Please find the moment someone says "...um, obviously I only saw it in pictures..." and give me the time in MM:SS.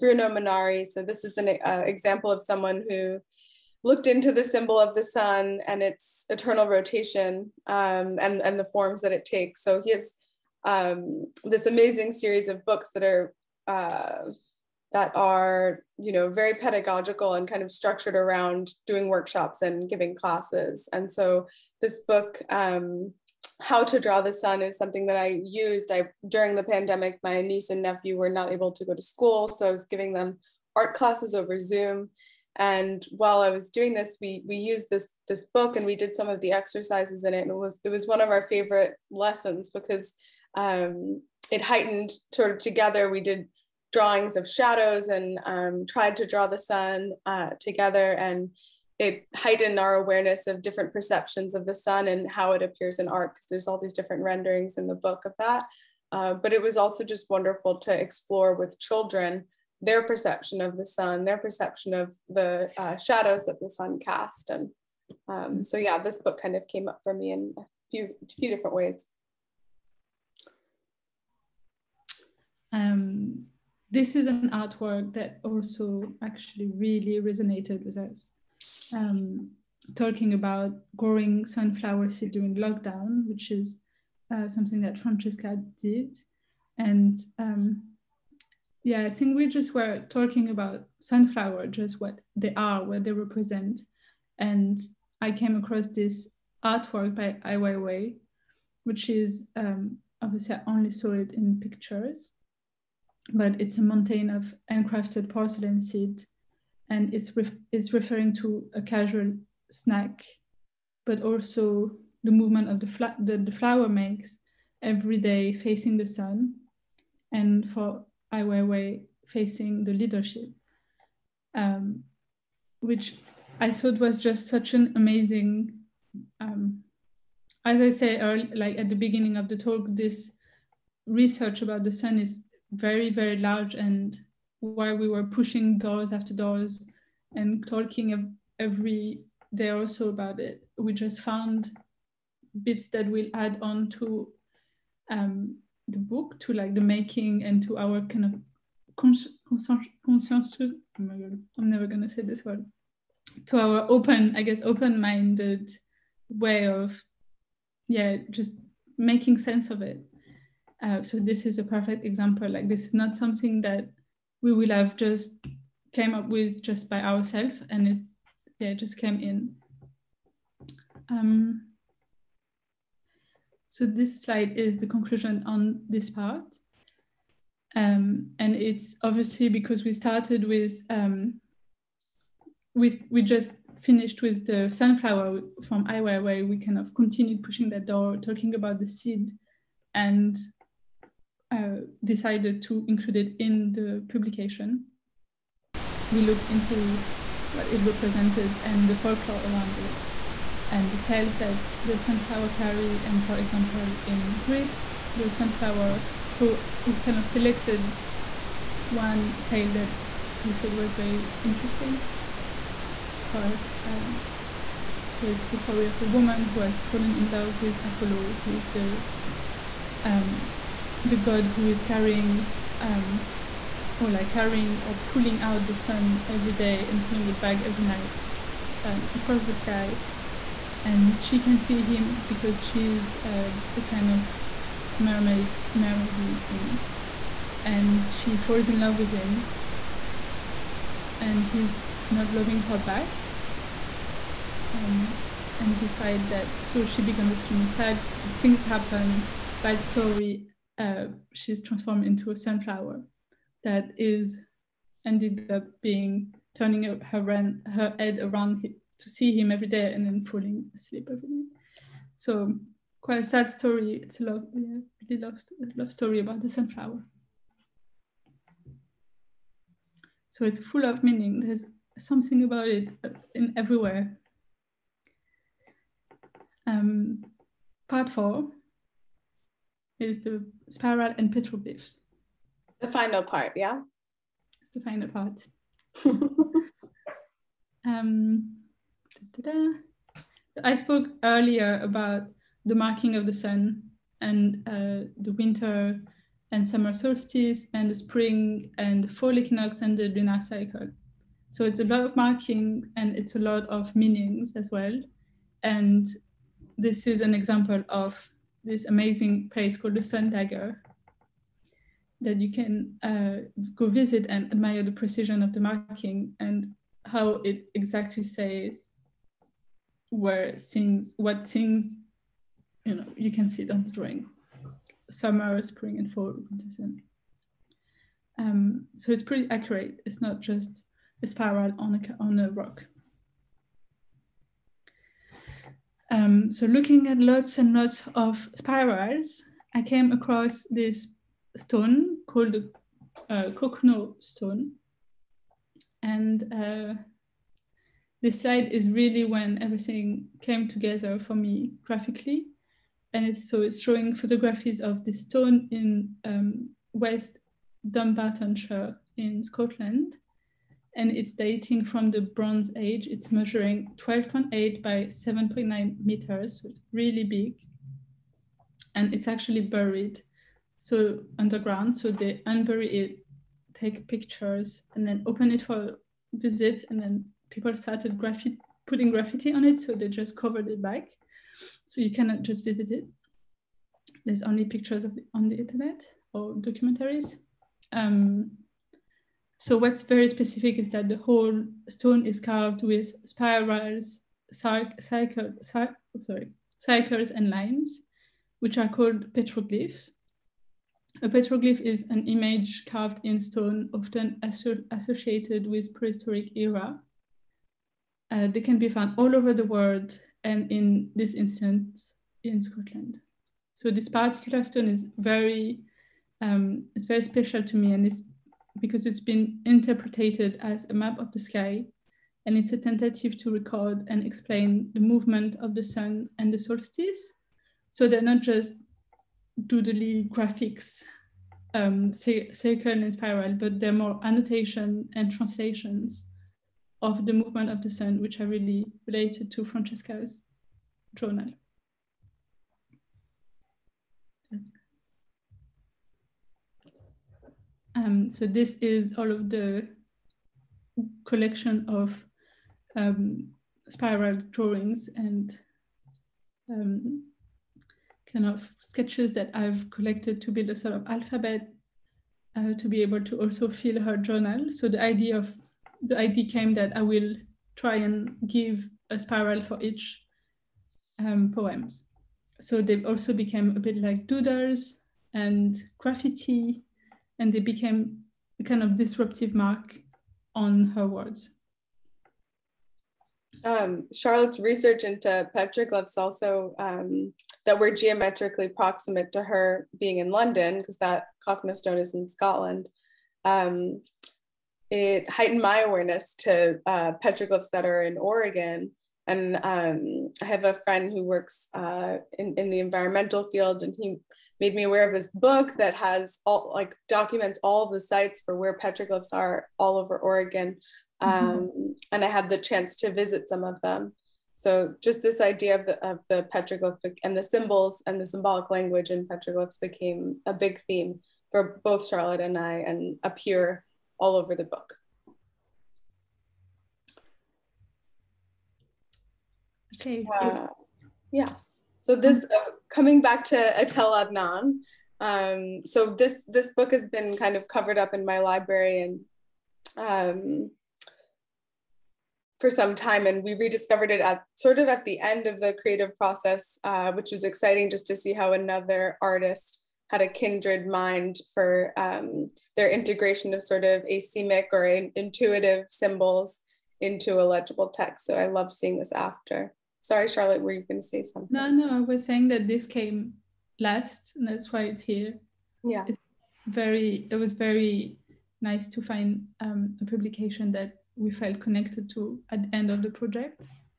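01:39.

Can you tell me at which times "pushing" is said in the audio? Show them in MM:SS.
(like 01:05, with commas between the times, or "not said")
02:15, 03:07.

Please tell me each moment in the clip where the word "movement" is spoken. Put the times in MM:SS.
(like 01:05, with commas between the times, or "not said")
01:52, 07:04, 07:17.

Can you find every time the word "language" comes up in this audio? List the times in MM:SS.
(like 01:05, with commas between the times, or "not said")
08:38.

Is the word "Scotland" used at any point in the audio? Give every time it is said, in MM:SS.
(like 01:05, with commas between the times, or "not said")
05:59, 06:52, 08:12.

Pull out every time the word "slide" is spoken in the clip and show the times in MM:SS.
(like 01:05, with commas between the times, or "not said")
02:54, 05:48.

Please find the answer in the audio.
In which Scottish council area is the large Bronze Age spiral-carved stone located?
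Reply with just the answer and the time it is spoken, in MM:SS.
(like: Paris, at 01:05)
West Dunbartonshire, at 05:56.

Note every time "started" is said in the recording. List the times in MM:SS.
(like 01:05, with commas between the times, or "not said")
02:59, 06:17.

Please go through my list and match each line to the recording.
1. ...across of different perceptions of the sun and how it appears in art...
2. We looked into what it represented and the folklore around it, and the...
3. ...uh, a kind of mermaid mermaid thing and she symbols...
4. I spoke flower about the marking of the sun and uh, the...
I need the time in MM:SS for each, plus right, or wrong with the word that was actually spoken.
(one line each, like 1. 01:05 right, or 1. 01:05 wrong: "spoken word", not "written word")
1. 00:49 wrong: "awareness", not "across"
2. 03:16 right
3. 03:53 wrong: "falls", not "symbols"
4. 04:50 wrong: "earlier", not "flower".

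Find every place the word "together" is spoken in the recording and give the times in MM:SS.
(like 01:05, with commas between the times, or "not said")
00:42, 00:47, 05:50.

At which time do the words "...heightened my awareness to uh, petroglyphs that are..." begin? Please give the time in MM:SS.
08:15.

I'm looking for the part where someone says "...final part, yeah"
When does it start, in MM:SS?
04:42.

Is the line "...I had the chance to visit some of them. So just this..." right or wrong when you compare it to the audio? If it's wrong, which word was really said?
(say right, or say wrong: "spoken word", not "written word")
right.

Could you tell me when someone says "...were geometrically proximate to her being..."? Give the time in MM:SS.
08:07.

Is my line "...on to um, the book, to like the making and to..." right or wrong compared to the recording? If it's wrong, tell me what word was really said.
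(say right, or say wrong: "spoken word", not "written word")
right.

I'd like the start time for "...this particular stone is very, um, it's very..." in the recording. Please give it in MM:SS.
06:53.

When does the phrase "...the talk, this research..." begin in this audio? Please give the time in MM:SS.
02:09.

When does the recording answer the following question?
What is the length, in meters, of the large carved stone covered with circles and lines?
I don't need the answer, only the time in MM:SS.
06:03.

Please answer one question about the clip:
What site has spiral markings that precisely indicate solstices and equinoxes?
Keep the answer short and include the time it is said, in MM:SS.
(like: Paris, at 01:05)
Sun Dagger, at 05:10.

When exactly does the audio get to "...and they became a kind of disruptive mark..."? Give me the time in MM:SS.
07:57.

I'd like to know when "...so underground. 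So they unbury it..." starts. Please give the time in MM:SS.
06:10.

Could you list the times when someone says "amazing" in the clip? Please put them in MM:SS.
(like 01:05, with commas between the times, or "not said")
00:11, 02:04, 05:08.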